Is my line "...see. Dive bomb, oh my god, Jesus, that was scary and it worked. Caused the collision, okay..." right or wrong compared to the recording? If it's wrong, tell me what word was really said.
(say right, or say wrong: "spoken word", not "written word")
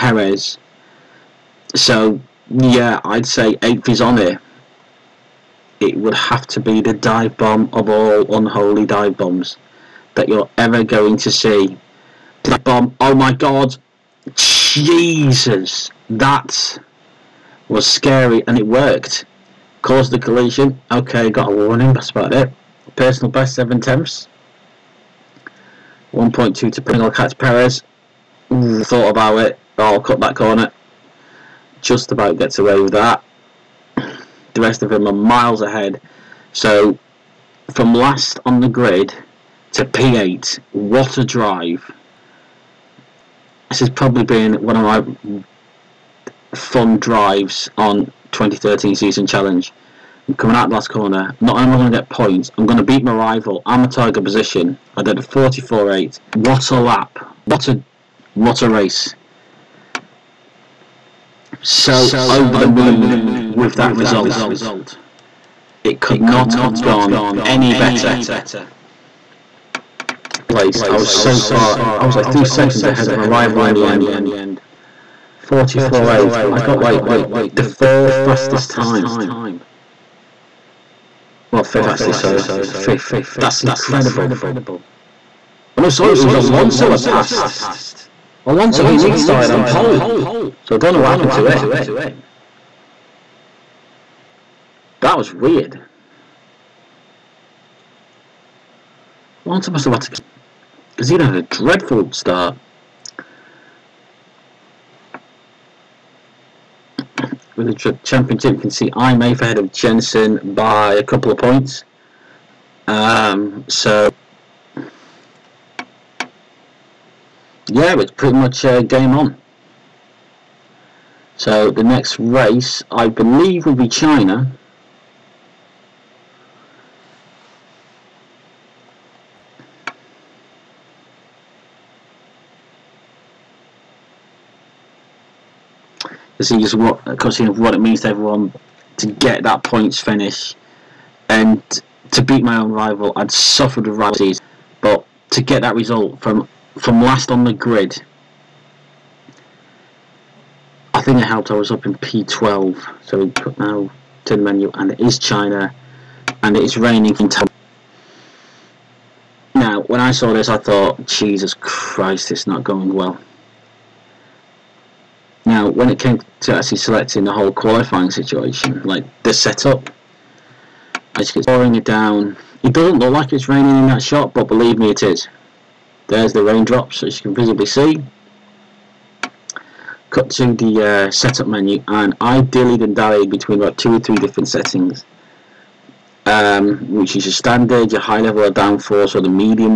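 right.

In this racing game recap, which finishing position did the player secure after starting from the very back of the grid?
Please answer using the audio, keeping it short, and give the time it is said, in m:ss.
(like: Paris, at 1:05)
P8, at 0:39.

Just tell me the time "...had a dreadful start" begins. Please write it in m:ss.
1:41.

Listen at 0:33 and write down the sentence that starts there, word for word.
The rest of them are miles ahead.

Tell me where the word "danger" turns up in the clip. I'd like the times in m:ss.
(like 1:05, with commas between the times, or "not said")
not said.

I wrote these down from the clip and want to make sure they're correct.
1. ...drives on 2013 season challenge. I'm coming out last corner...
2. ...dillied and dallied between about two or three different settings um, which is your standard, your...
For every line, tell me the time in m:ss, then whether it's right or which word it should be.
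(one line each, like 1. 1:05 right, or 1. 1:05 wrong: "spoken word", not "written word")
1. 0:46 right
2. 3:02 right.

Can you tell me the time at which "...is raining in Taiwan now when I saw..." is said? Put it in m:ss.
2:36.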